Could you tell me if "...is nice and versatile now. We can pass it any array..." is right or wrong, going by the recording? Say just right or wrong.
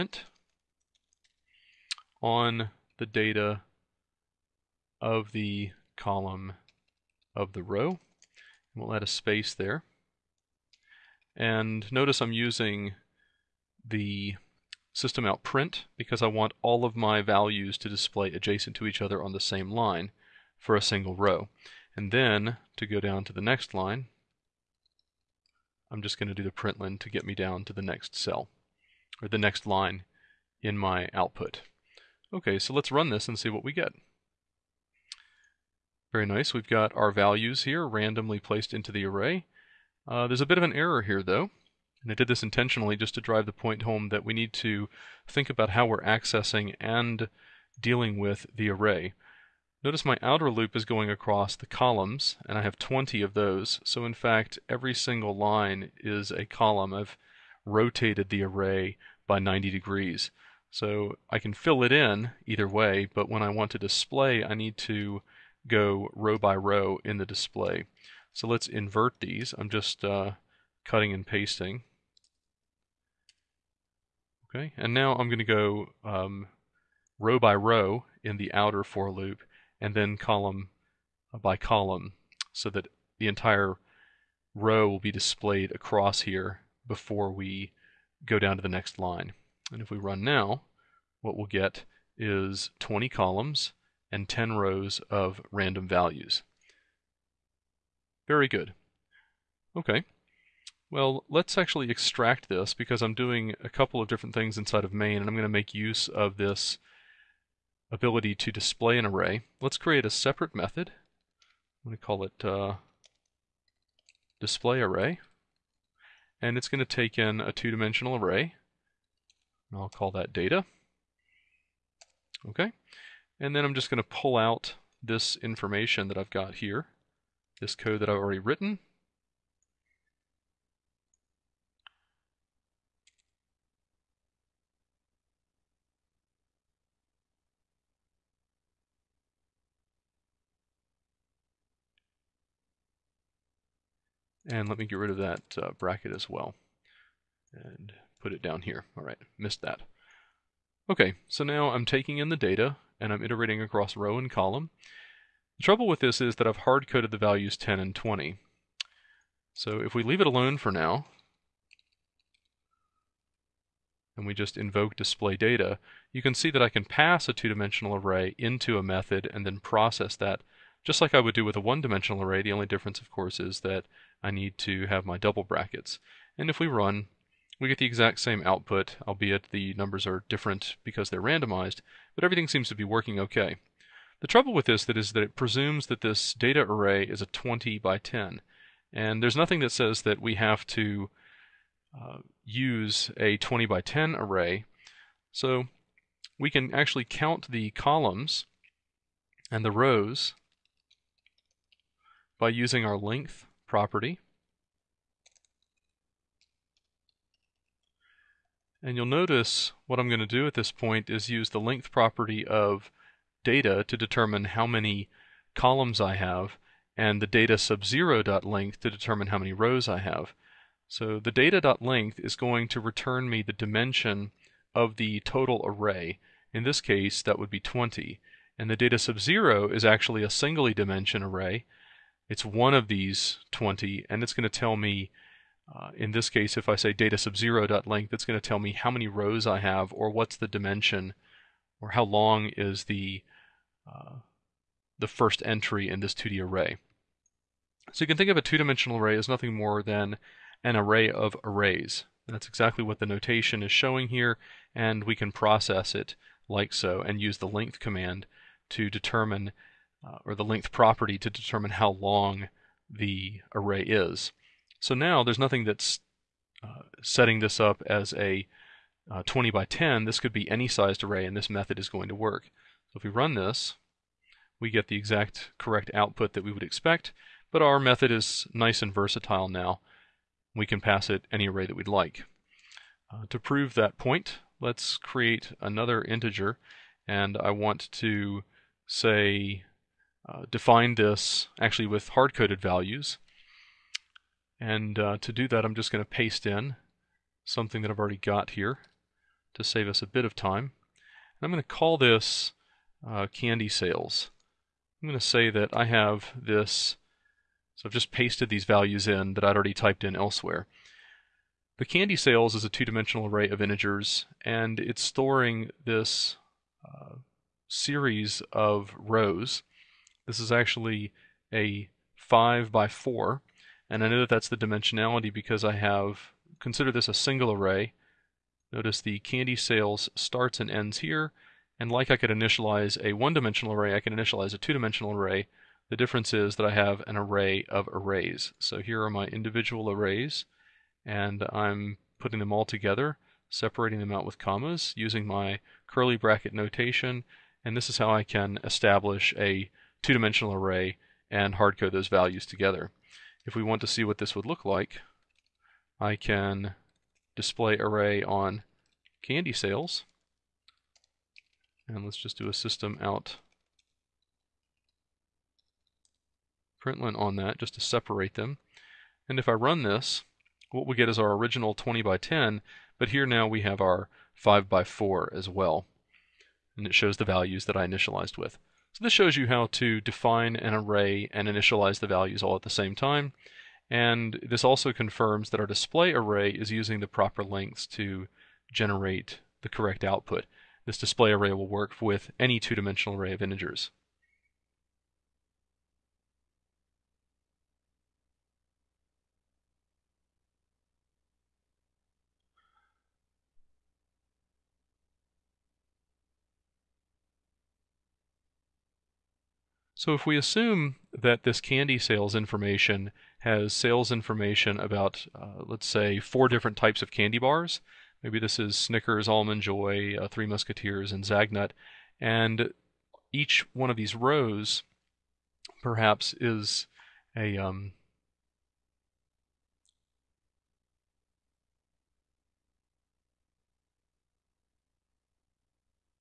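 right.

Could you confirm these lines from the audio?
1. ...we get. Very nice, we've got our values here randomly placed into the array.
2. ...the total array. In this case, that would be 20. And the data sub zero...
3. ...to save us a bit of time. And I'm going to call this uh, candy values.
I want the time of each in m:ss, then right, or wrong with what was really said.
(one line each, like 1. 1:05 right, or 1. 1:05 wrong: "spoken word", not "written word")
1. 0:33 right
2. 3:44 right
3. 4:59 wrong: "sales", not "values".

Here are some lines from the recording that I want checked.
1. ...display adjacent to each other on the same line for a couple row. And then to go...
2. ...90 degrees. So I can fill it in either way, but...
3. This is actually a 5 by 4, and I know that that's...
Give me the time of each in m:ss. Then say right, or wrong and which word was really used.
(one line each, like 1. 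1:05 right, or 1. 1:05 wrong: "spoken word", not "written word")
1. 0:17 wrong: "single", not "couple"
2. 0:59 right
3. 5:20 right.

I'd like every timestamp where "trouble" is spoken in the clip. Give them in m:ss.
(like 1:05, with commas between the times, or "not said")
2:35, 3:04.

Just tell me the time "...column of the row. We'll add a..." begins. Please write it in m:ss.
0:05.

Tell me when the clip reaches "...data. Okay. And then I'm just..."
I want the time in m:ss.
2:00.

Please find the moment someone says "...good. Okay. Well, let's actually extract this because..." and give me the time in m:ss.
1:38.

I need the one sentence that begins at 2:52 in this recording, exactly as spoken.
The only difference, of course, is that I need to have my double brackets.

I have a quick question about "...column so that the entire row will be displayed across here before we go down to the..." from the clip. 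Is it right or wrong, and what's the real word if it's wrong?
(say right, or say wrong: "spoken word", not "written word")
right.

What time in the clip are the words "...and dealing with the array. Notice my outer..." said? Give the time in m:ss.
0:46.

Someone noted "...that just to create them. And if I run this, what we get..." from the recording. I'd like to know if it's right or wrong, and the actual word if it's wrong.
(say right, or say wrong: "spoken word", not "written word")
wrong: "separate", not "create".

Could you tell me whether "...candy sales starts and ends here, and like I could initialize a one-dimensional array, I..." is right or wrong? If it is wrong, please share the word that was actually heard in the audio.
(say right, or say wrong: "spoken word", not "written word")
right.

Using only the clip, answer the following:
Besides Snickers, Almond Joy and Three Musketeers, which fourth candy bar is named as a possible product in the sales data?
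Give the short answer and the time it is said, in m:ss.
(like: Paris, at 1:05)
Zagnut, at 7:01.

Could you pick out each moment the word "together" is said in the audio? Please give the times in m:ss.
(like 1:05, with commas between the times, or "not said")
5:42, 5:52.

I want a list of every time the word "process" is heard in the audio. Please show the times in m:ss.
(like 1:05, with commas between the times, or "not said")
2:49, 4:15.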